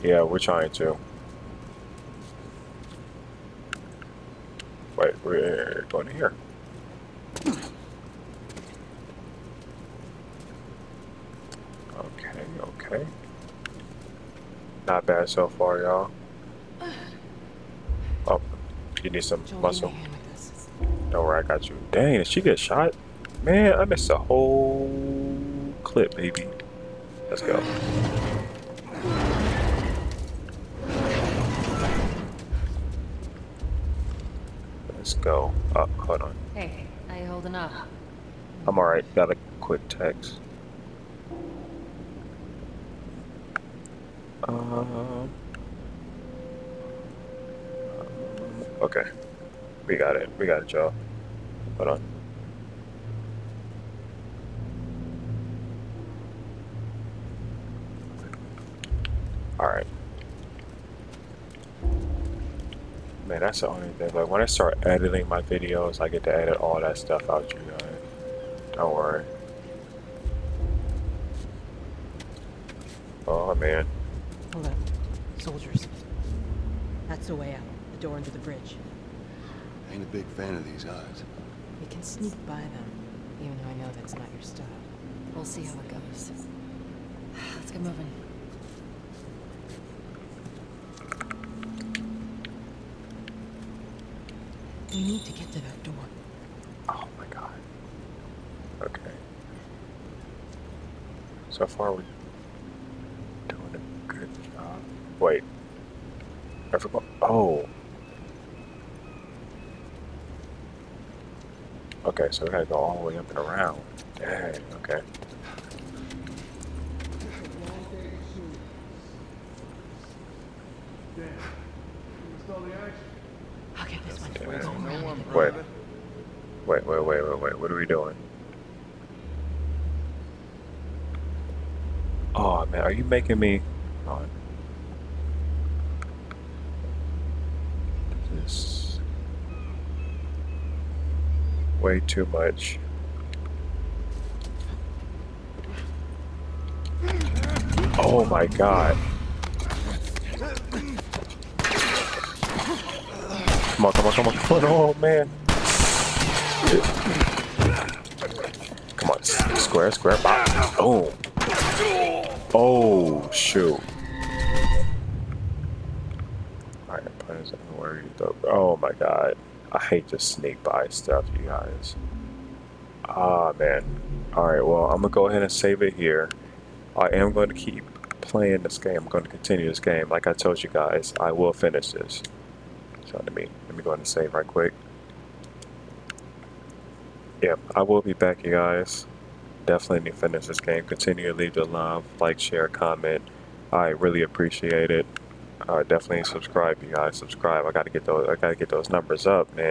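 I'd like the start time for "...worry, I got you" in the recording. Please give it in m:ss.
0:21.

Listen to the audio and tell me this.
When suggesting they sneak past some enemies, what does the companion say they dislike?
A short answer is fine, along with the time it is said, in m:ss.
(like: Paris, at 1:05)
These eyes, at 1:20.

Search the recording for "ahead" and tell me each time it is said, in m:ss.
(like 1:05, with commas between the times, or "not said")
2:55, 3:03.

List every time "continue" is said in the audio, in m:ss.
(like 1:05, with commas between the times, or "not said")
2:59, 3:10.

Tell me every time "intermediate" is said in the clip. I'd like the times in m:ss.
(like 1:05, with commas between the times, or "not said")
not said.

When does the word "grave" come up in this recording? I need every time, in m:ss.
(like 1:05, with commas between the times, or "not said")
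not said.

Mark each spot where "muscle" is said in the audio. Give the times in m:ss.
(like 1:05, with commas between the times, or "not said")
0:19.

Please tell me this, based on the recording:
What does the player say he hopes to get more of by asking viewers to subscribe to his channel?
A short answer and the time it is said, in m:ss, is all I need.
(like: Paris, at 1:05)
Numbers, at 3:18.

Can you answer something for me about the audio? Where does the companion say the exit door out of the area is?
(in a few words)
Under the bridge.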